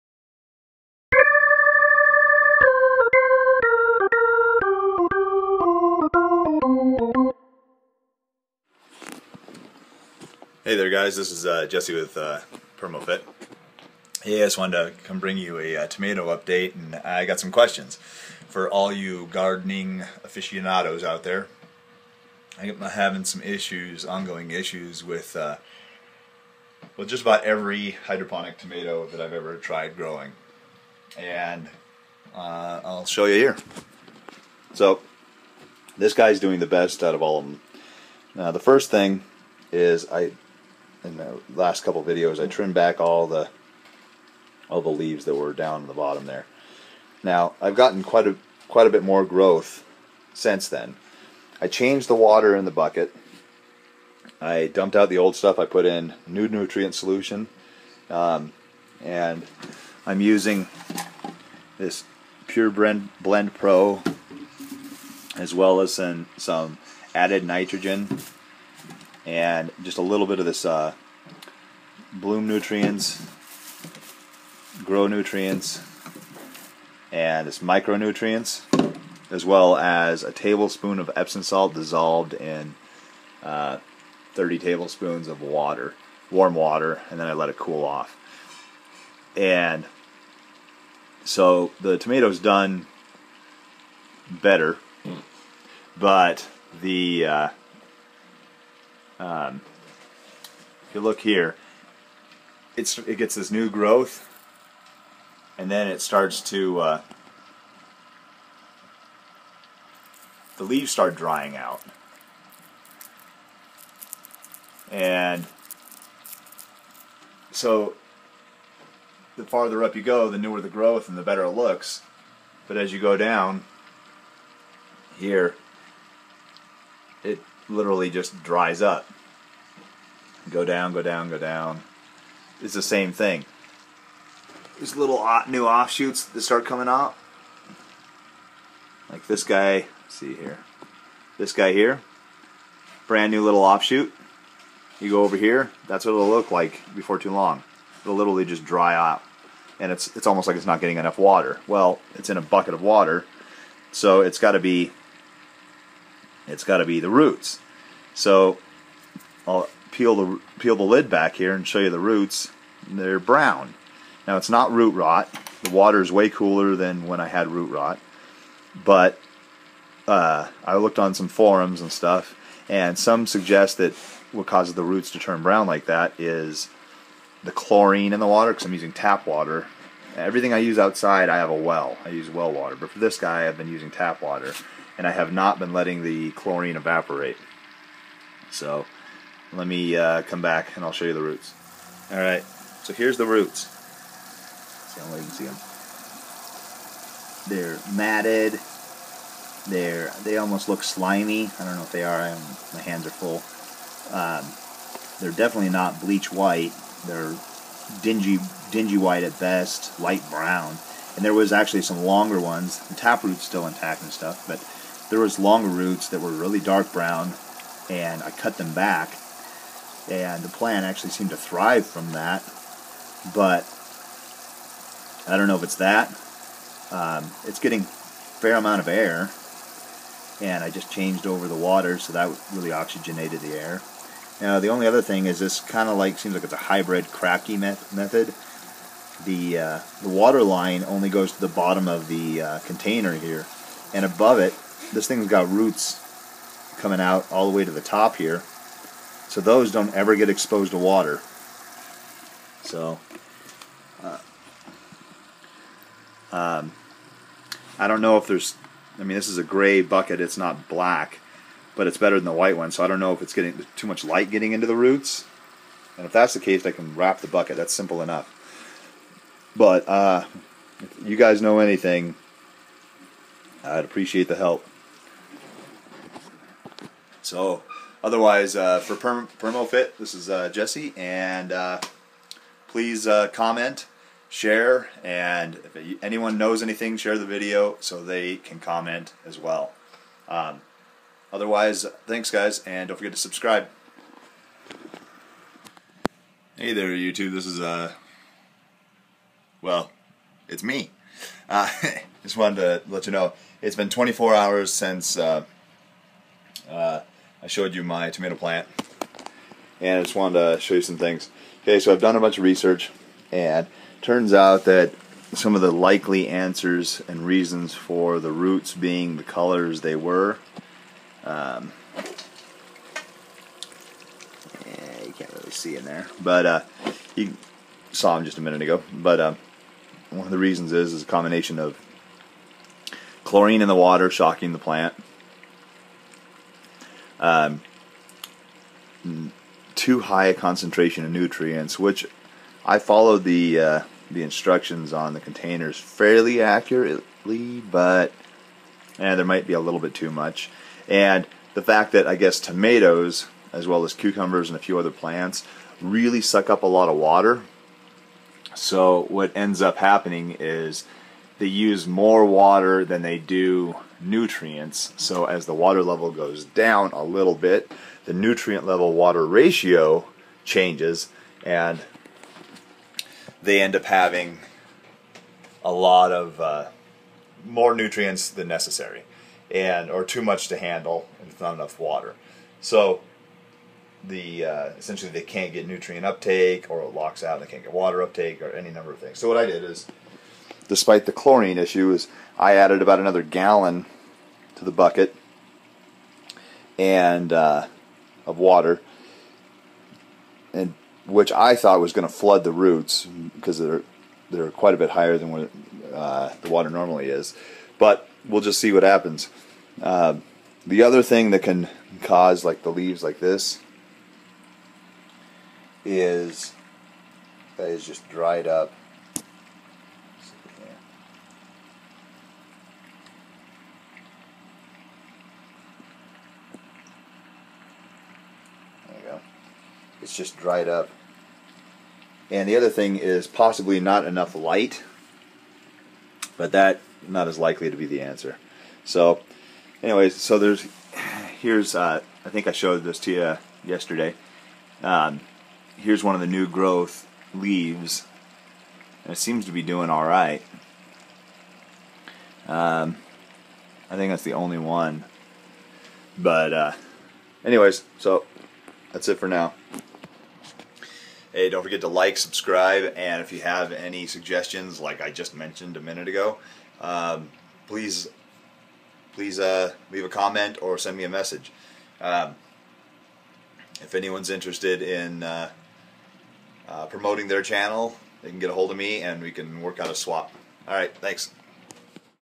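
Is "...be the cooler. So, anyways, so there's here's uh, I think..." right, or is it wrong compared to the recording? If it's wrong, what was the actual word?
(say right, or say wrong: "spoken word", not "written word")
wrong: "answer", not "cooler".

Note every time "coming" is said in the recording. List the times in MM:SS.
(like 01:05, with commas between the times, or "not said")
02:16, 04:06.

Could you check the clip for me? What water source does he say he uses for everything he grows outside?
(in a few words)
Well water.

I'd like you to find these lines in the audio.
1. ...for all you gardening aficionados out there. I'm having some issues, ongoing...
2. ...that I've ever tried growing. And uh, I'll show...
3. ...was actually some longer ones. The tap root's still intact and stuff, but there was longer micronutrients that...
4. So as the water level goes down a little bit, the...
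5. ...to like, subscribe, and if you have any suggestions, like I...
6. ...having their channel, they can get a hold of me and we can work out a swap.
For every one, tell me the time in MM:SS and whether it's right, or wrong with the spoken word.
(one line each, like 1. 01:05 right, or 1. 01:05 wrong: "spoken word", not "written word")
1. 00:18 right
2. 00:29 right
3. 03:31 wrong: "roots", not "micronutrients"
4. 06:04 right
5. 07:41 right
6. 07:56 wrong: "promoting", not "having".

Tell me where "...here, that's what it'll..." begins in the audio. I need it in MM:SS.
02:25.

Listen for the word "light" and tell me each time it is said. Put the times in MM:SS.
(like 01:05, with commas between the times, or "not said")
03:29, 04:24, 07:14.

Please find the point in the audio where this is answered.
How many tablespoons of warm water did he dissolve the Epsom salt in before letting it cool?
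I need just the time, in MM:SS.
01:24.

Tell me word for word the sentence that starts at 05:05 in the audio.
Uh, uh I showed you my tomato plant and I just wanted to show you some things.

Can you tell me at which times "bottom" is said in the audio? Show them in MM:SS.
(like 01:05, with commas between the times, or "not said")
00:45, 04:01.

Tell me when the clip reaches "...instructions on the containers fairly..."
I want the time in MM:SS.
05:44.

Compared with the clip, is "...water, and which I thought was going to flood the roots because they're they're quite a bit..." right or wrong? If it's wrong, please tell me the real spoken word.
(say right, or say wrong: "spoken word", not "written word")
right.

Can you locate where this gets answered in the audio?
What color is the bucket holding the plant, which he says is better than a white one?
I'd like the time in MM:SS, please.
04:19.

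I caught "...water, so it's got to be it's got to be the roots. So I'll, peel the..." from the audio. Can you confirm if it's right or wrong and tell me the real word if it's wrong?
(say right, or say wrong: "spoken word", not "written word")
right.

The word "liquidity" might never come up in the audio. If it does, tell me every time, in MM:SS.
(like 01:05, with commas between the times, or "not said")
not said.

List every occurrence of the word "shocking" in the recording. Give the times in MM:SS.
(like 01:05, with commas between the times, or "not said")
05:34.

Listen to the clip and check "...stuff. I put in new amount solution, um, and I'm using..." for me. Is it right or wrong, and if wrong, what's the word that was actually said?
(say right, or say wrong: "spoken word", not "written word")
wrong: "nutrient", not "amount".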